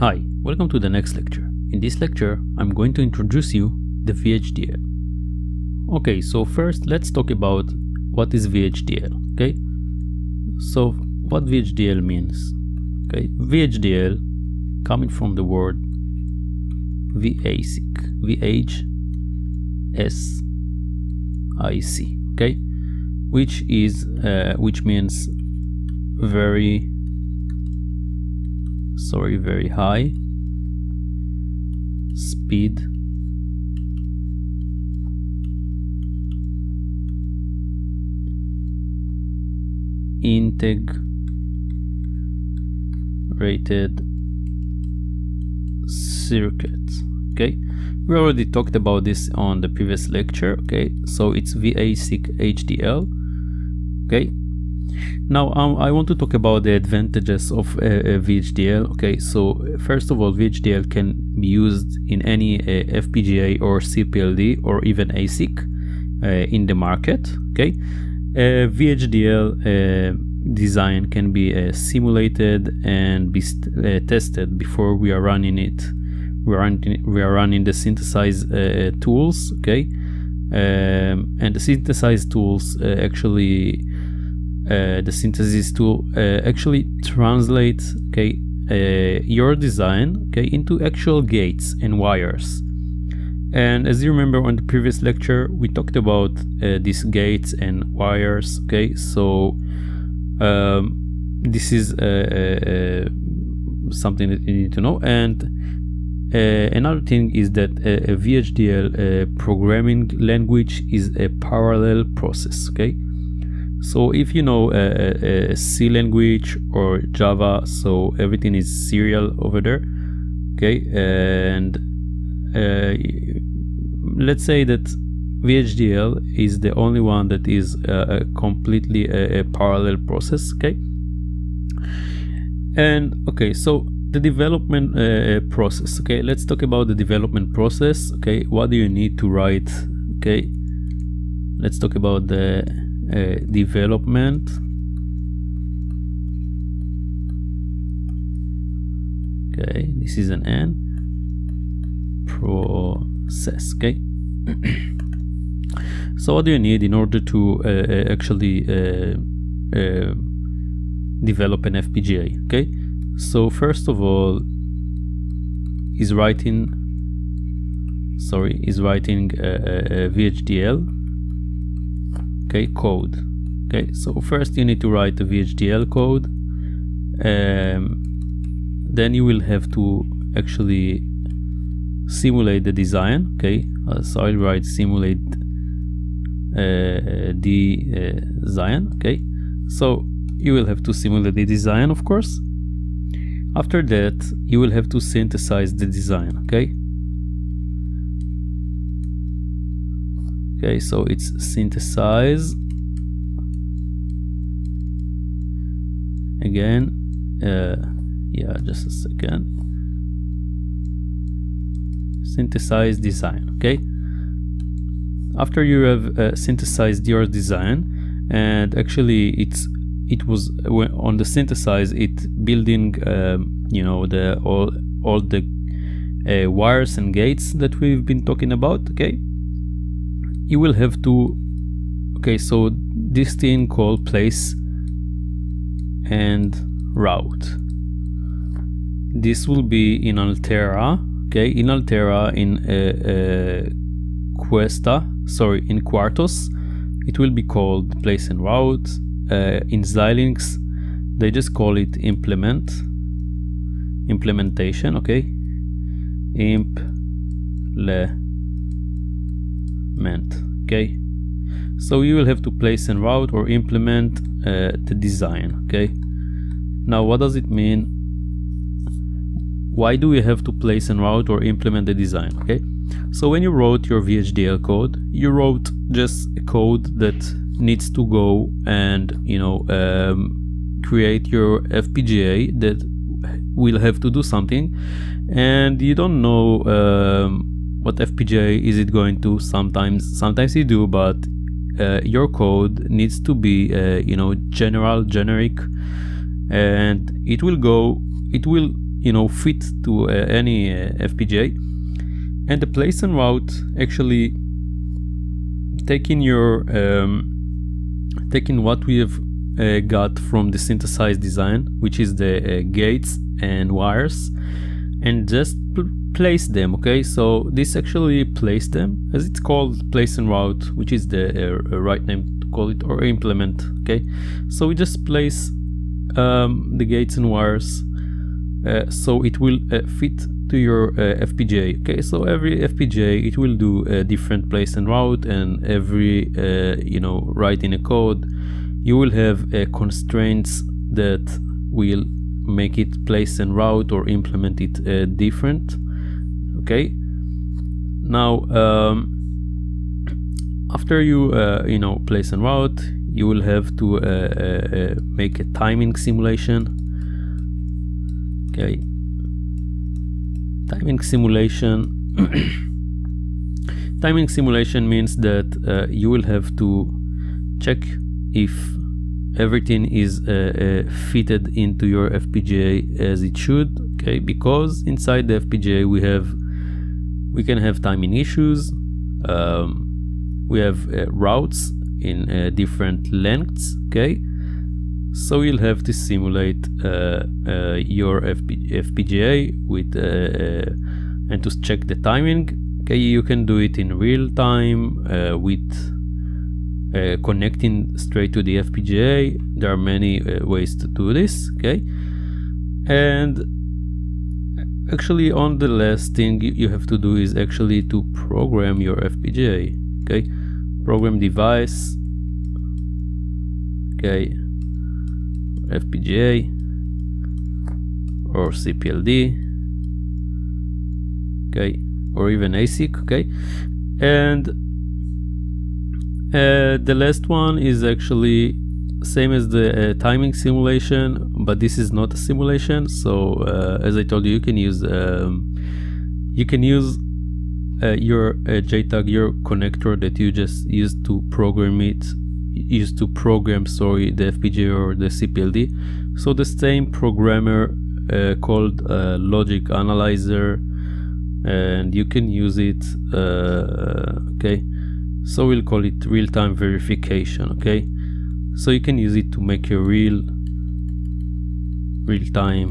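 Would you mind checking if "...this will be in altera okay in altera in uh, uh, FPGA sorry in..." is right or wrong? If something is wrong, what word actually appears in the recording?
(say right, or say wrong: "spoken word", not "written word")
wrong: "Questa", not "FPGA".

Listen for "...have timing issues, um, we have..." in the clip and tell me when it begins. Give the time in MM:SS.
06:17.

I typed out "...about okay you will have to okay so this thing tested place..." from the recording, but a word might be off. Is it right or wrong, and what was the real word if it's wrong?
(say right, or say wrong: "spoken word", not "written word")
wrong: "called", not "tested".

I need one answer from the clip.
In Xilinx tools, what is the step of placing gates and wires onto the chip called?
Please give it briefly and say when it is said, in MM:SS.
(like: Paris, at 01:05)
Implementation, at 04:14.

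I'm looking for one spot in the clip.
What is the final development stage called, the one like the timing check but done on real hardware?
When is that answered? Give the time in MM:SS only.
07:36.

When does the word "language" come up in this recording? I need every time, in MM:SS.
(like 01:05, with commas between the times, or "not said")
01:50, 01:55.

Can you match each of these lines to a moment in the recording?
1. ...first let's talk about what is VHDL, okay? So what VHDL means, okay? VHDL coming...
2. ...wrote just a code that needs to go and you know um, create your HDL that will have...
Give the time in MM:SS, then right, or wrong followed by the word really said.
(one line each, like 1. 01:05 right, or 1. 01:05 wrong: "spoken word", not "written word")
1. 00:06 right
2. 04:35 wrong: "FPGA", not "HDL".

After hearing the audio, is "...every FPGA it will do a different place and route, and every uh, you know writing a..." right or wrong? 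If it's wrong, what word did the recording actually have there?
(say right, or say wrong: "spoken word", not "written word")
right.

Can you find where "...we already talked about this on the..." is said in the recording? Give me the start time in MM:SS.
00:48.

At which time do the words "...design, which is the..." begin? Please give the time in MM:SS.
05:11.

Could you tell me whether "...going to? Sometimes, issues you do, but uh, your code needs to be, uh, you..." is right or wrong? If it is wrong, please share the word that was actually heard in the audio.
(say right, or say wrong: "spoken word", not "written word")
wrong: "sometimes", not "issues".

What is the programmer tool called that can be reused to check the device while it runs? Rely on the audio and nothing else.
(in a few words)
Logic analyzer.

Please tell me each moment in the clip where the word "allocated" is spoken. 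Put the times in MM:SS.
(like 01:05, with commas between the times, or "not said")
not said.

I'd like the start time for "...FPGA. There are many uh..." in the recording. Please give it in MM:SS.
06:38.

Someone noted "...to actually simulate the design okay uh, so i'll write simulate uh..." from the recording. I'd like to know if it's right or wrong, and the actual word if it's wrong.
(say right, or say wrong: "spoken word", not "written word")
right.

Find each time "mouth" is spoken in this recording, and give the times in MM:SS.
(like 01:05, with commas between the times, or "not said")
not said.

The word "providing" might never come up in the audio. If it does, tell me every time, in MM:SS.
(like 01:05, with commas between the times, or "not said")
not said.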